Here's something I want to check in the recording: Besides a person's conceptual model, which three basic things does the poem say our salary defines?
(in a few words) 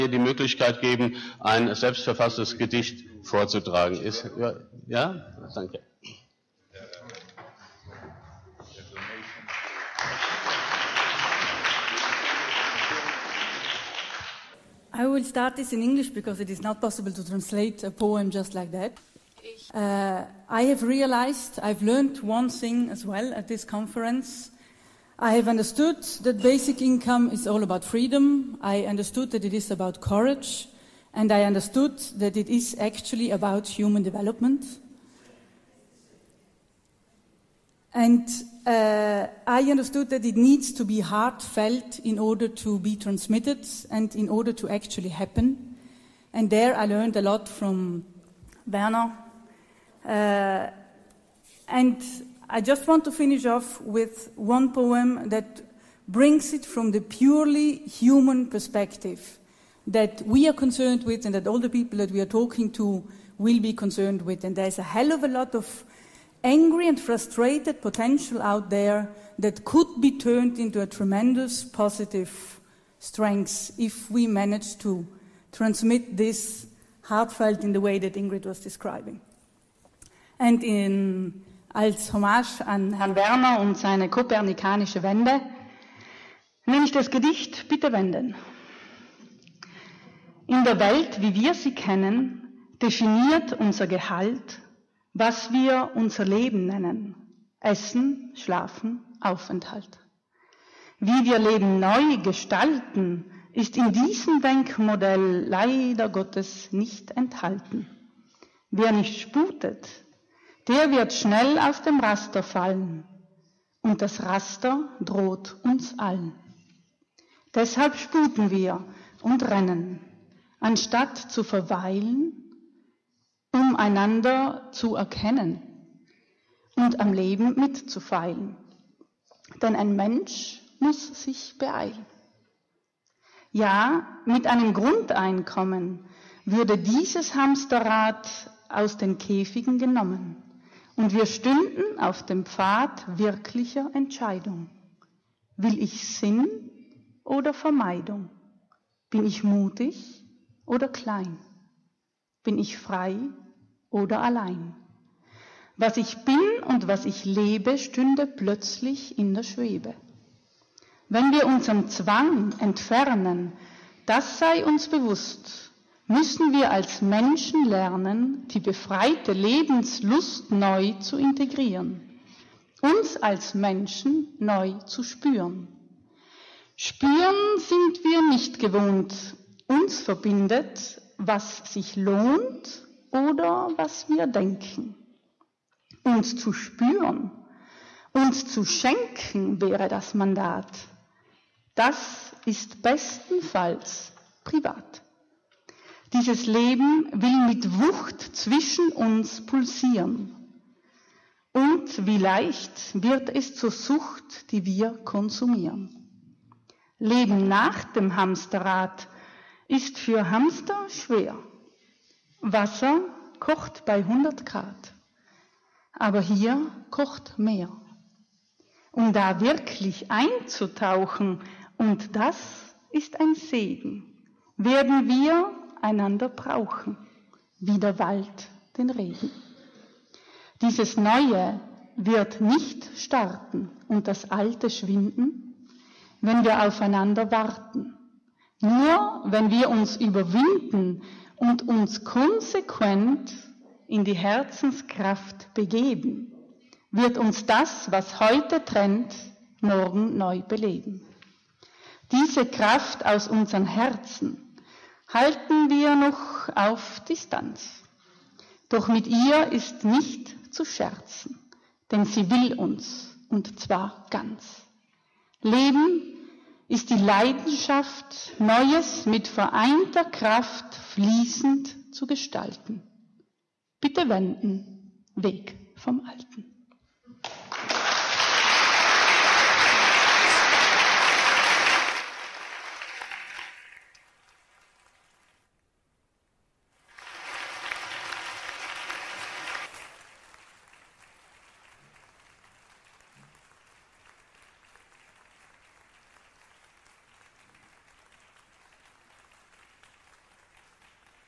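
Essen, Schlafen, Aufenthalt.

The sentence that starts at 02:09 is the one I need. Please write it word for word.
Denn ein Mensch muss sich beeilen.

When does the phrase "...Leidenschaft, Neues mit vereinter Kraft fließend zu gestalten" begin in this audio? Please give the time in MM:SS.
04:26.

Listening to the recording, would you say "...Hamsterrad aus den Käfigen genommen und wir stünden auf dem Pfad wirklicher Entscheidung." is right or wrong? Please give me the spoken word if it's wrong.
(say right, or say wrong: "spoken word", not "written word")
right.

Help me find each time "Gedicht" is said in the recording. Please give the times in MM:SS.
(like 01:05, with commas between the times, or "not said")
00:02, 01:27.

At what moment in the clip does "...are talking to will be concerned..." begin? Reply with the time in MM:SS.
01:02.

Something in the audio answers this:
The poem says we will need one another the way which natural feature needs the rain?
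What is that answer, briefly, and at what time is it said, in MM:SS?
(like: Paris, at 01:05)
Wald, at 03:47.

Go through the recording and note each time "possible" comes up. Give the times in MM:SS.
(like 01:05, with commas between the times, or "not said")
00:16.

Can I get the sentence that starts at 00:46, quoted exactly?
And there I learned a lot from Werner.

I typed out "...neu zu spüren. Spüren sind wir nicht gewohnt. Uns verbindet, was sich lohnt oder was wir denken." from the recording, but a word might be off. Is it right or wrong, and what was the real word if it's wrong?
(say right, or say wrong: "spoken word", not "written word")
right.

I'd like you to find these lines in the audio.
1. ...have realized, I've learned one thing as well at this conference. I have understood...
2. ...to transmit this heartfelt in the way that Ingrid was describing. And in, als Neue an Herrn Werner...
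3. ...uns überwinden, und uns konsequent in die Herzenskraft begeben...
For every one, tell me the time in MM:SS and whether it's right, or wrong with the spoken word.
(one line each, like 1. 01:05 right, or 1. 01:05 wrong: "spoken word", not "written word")
1. 00:20 right
2. 01:14 wrong: "Hommage", not "Neue"
3. 03:59 right.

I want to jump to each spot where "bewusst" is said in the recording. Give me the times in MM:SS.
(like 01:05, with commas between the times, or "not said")
02:44.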